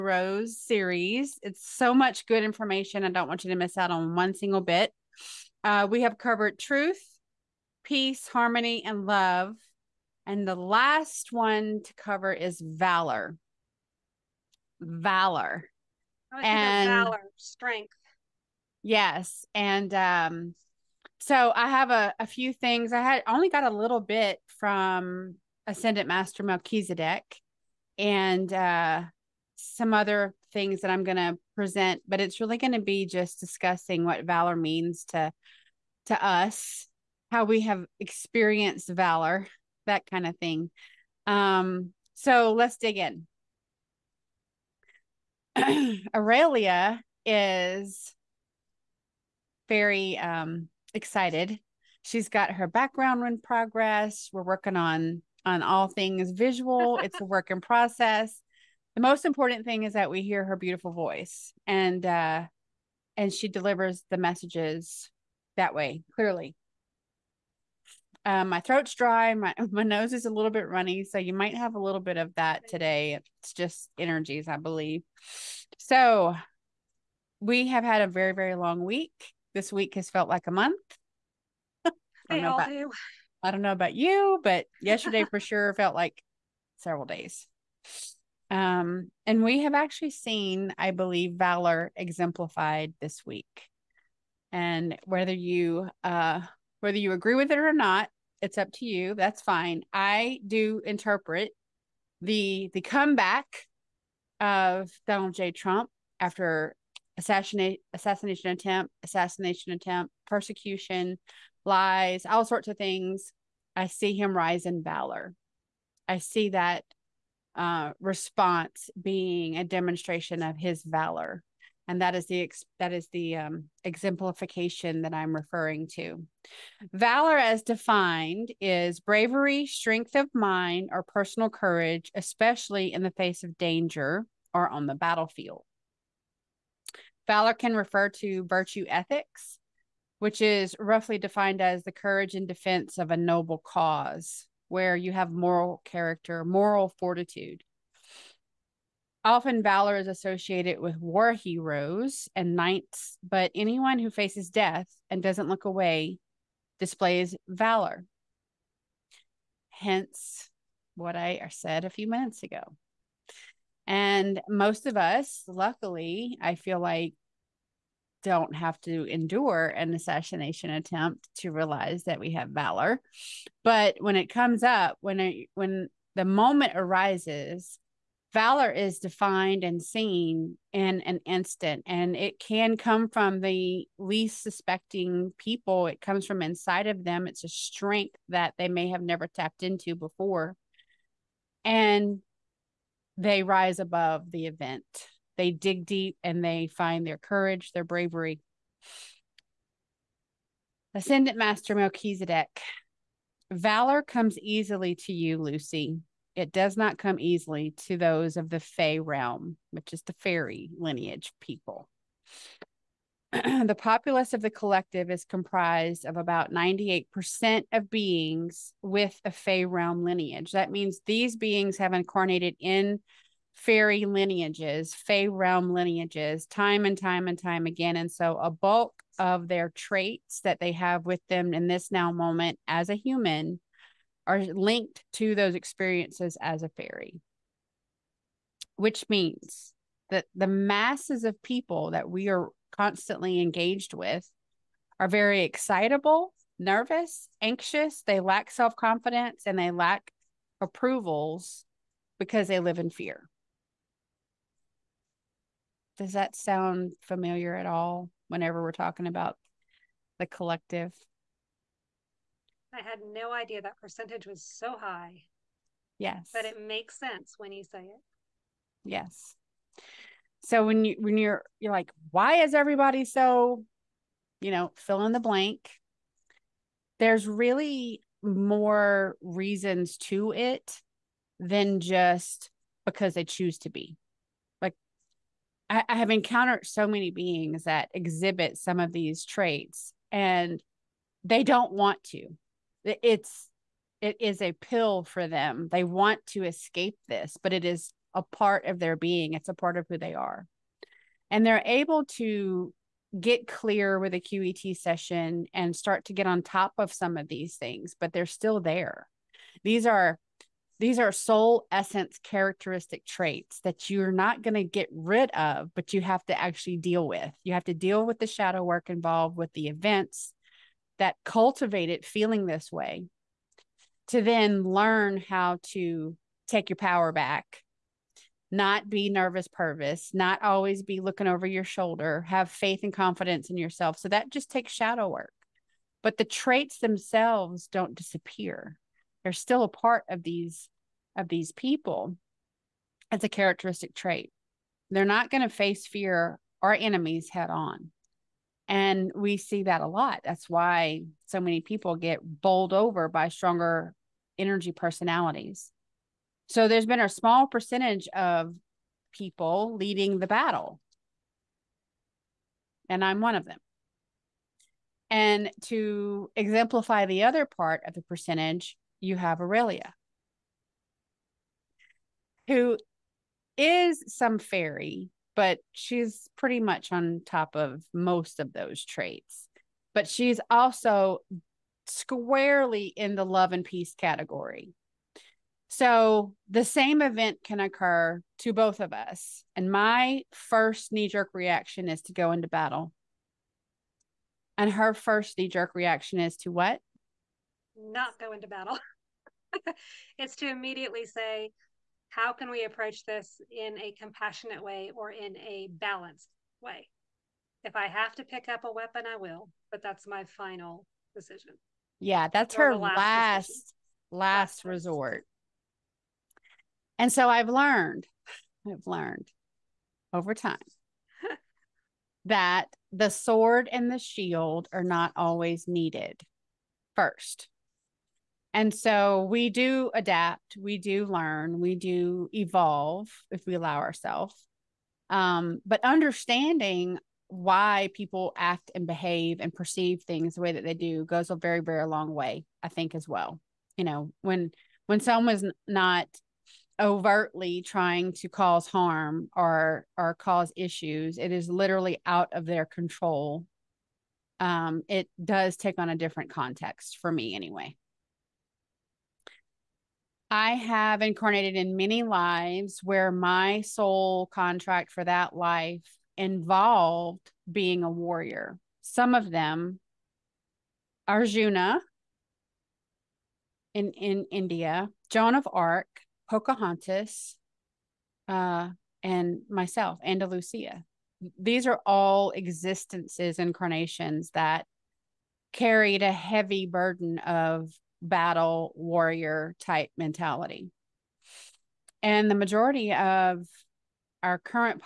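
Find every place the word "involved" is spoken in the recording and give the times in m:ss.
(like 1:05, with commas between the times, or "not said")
5:18, 7:46.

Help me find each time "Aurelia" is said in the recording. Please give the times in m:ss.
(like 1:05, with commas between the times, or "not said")
0:46, 6:09.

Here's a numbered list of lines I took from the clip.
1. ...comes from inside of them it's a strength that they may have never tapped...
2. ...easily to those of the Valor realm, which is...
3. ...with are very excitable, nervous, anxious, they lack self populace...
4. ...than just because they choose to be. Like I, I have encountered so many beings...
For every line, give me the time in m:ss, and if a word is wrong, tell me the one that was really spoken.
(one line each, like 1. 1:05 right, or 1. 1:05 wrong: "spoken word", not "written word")
1. 3:06 right
2. 3:27 wrong: "Fey", not "Valor"
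3. 4:03 wrong: "confidence", not "populace"
4. 4:41 right.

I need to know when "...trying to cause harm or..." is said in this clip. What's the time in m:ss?
7:27.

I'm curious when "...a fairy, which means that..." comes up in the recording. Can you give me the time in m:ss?
3:56.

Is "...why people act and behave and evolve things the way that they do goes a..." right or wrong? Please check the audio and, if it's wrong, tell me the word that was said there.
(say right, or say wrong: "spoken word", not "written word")
wrong: "perceive", not "evolve".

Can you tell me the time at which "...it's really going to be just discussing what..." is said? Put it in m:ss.
0:32.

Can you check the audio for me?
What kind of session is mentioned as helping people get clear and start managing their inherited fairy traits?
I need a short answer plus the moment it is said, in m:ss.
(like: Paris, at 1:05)
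QET session, at 5:04.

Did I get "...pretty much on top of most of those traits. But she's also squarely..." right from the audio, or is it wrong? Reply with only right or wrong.
right.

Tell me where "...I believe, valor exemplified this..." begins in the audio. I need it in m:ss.
1:30.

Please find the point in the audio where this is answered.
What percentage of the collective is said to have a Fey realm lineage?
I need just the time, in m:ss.
3:36.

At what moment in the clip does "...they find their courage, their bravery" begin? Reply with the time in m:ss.
3:16.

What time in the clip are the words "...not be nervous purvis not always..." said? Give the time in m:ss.
5:28.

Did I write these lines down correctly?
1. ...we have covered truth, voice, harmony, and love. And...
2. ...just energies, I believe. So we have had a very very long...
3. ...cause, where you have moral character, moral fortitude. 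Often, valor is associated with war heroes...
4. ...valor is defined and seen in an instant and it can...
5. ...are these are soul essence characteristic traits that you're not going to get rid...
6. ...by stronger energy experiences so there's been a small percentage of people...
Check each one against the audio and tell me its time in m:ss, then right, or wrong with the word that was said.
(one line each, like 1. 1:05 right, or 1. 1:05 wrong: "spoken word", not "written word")
1. 0:05 wrong: "peace", not "voice"
2. 1:13 right
3. 2:23 right
4. 2:58 right
5. 5:09 right
6. 5:53 wrong: "personalities", not "experiences".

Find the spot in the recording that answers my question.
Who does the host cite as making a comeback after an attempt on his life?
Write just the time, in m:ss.
1:45.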